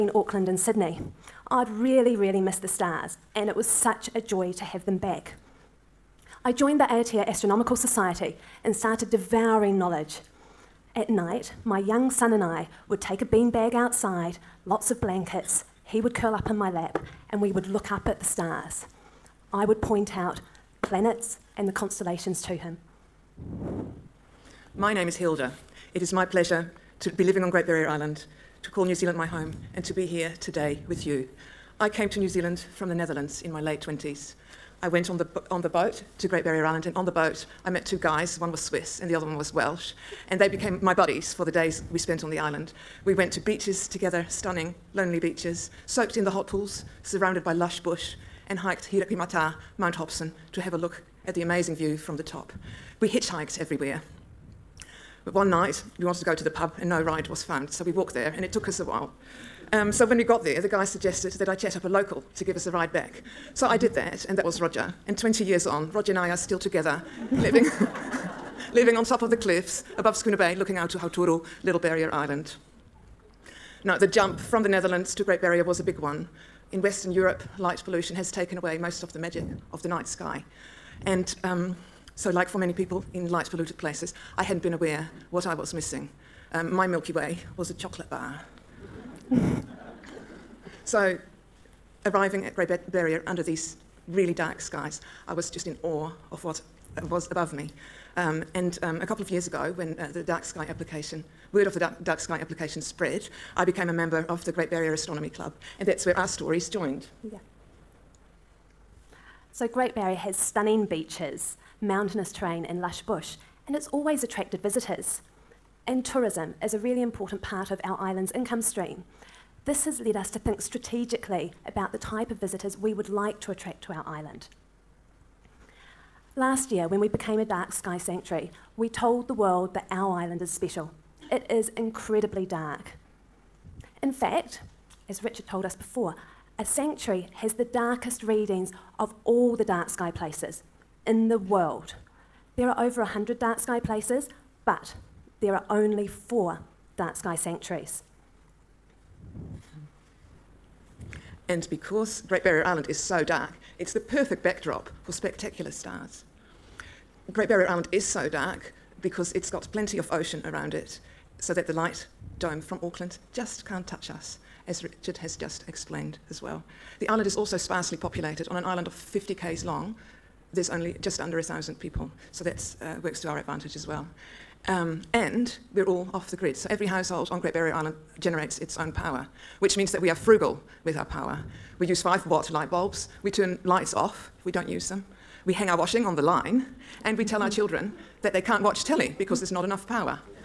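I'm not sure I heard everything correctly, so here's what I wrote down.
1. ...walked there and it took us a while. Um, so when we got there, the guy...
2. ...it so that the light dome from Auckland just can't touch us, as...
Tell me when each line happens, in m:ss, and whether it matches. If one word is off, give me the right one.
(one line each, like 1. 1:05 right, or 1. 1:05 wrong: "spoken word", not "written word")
1. 0:57 right
2. 2:40 right.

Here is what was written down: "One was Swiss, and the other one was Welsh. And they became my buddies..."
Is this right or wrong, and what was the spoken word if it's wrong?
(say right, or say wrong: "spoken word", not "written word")
right.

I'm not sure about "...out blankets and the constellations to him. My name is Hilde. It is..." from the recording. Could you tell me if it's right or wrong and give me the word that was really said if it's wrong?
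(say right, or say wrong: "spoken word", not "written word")
wrong: "planets", not "blankets".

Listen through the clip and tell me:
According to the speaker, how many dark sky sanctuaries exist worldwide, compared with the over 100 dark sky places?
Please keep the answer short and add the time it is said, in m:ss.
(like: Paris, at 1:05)
4, at 2:26.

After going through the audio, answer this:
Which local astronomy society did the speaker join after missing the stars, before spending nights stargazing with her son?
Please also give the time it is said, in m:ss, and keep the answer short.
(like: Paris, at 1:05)
Aotea Astronomical Society, at 0:06.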